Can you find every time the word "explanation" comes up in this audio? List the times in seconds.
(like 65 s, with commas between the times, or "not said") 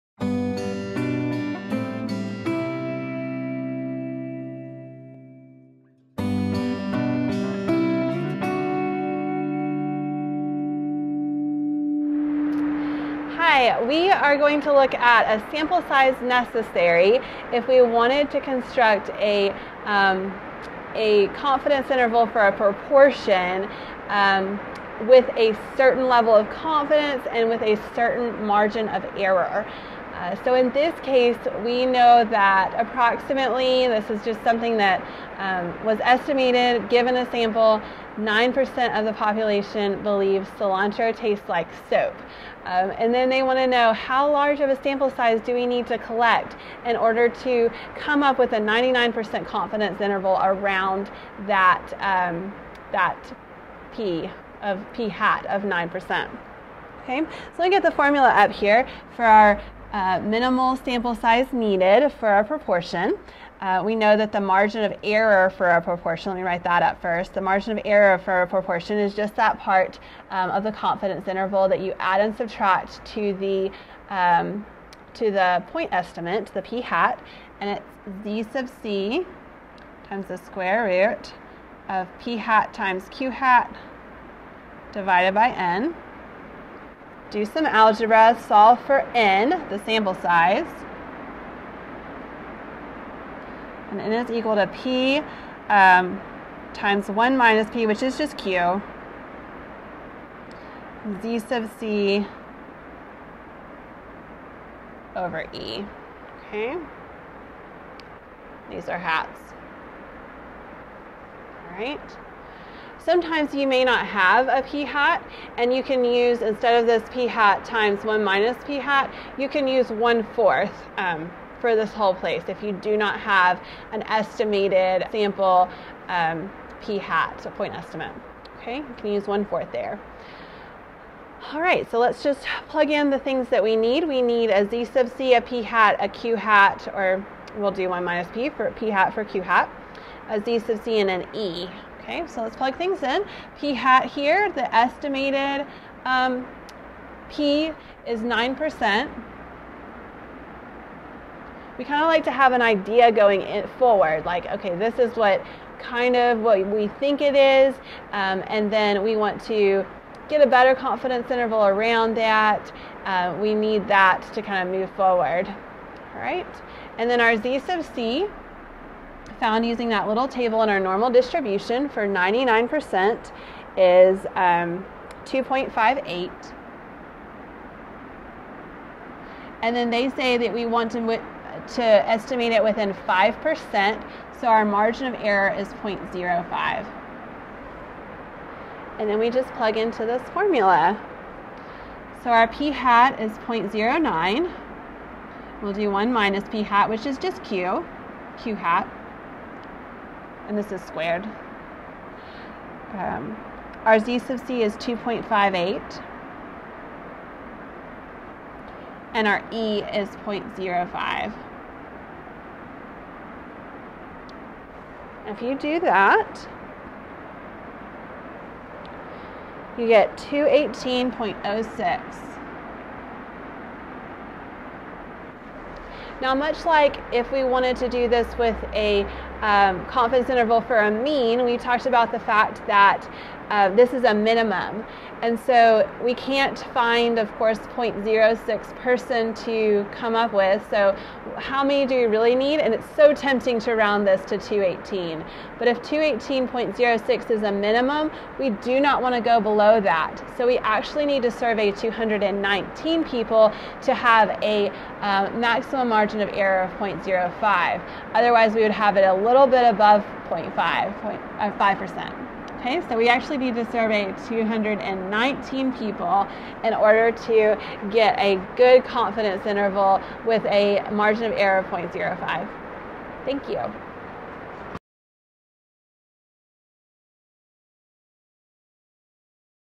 not said.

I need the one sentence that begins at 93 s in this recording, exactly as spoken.
And n is equal to p um, times 1 minus p, which is just q, z sub c over e.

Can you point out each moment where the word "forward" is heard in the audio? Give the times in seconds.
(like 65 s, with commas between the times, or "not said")
153 s, 164 s.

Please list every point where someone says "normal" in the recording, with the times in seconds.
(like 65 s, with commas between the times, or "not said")
170 s.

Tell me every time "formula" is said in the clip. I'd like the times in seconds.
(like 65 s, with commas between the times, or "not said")
57 s, 190 s.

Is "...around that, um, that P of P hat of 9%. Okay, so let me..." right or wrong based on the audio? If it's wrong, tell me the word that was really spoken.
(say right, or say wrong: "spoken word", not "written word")
right.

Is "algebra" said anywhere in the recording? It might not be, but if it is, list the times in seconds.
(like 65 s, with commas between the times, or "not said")
87 s.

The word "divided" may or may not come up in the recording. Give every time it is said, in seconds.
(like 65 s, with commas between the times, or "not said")
84 s.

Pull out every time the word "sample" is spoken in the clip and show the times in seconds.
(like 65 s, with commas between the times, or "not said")
15 s, 37 s, 44 s, 60 s, 89 s, 125 s.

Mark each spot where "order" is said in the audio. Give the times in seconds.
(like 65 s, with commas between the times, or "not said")
46 s, 266 s.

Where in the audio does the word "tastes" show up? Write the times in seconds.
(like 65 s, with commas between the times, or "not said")
41 s.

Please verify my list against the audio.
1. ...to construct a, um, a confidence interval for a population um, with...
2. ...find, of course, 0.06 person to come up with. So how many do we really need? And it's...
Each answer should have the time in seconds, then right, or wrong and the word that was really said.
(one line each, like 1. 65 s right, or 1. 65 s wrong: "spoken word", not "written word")
1. 18 s wrong: "proportion", not "population"
2. 236 s right.